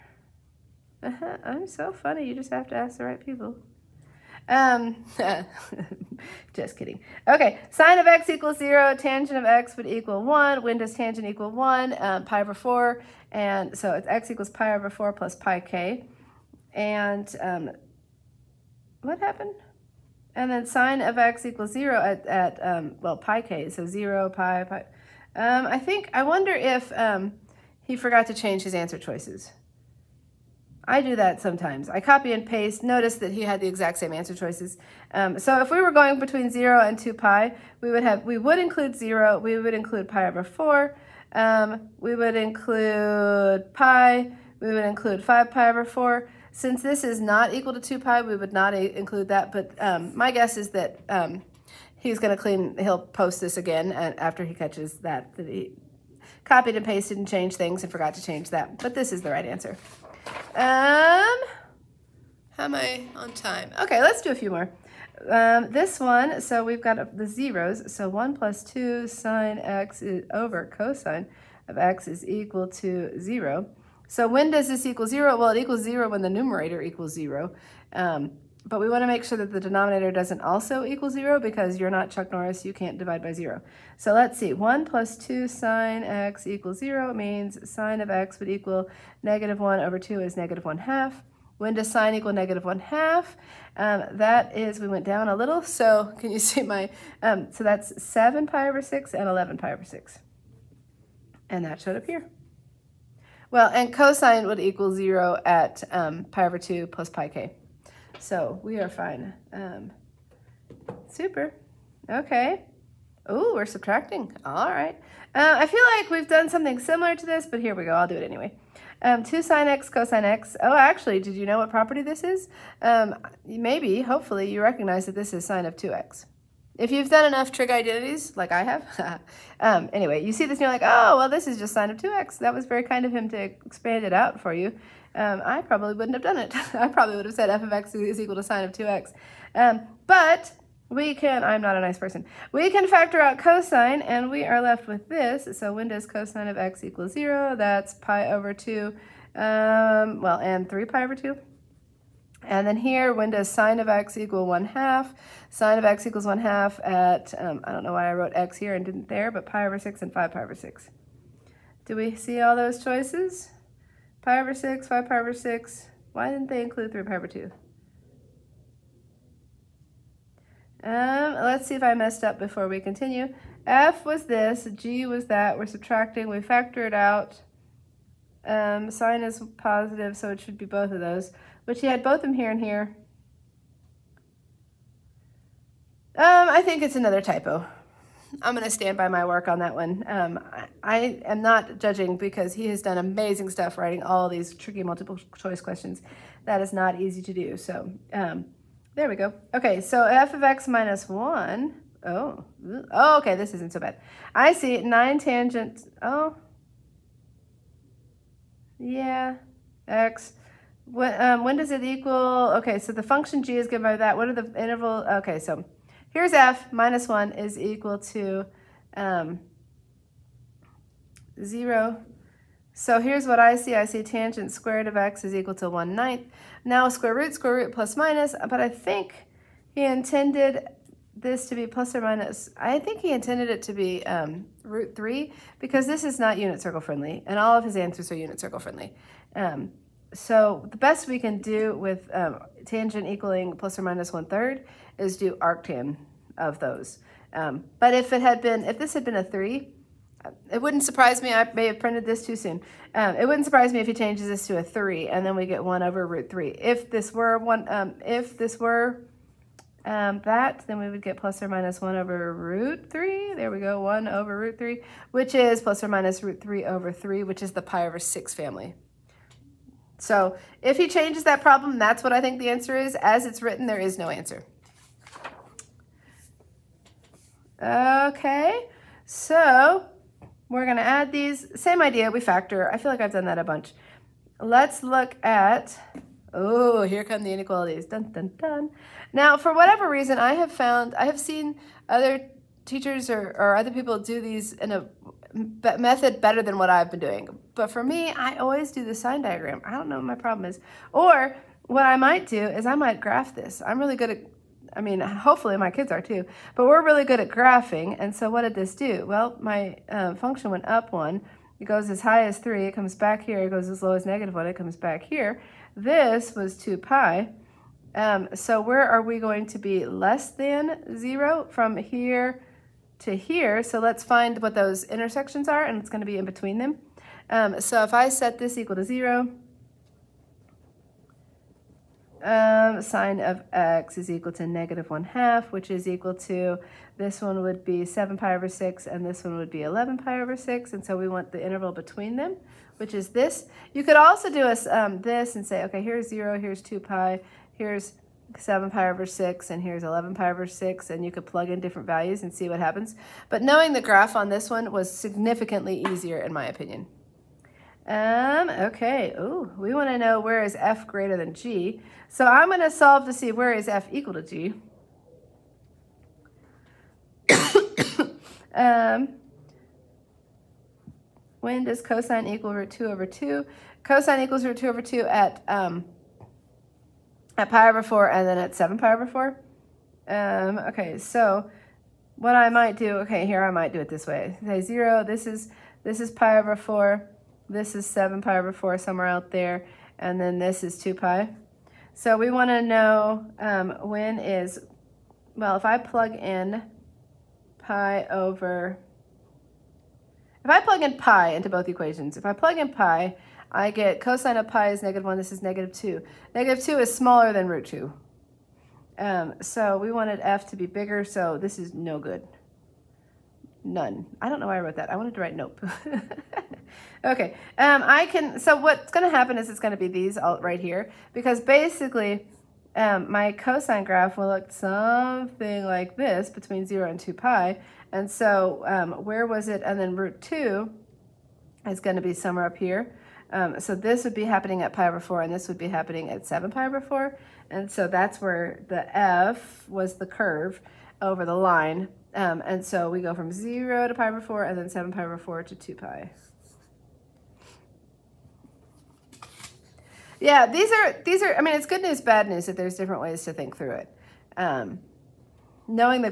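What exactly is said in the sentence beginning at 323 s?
So let's find what those intersections are and it's gonna be in between them.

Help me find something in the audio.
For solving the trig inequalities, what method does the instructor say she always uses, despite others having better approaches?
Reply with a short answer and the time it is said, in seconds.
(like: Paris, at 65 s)
sign diagram, at 298 s.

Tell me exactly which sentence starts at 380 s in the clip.
Um, okay, so what I might do, okay, here I might do it this way.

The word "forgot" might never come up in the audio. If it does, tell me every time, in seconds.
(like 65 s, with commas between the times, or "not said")
27 s, 57 s.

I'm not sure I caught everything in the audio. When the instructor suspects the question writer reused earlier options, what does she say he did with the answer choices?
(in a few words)
copy and paste.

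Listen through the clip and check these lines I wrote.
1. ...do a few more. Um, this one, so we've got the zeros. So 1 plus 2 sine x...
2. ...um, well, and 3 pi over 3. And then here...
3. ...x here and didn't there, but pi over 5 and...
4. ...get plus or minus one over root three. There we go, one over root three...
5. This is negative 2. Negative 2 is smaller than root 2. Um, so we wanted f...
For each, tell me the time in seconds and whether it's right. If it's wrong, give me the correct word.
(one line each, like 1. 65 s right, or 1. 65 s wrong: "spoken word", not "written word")
1. 64 s right
2. 149 s wrong: "2", not "3"
3. 158 s wrong: "6", not "5"
4. 261 s right
5. 405 s right.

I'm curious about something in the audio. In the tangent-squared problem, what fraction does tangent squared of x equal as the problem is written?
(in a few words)
1/9.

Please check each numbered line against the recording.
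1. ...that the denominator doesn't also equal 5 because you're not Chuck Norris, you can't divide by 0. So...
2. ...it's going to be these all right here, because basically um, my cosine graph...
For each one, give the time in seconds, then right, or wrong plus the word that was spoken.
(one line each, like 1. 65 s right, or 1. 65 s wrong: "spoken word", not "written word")
1. 79 s wrong: "0", not "5"
2. 419 s right.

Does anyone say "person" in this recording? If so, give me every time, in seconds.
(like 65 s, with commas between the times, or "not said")
141 s.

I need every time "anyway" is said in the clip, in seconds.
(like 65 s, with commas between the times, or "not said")
118 s, 129 s.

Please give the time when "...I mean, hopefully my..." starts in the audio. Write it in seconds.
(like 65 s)
304 s.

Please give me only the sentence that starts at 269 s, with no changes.
So if he changes that problem, that's what I think the answer is.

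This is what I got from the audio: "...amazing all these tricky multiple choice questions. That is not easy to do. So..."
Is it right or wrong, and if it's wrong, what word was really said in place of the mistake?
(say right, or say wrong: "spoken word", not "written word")
wrong: "writing", not "amazing".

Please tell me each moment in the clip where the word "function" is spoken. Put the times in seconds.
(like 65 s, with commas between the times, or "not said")
213 s, 310 s.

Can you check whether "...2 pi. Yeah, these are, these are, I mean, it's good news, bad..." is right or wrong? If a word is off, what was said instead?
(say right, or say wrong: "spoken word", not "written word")
right.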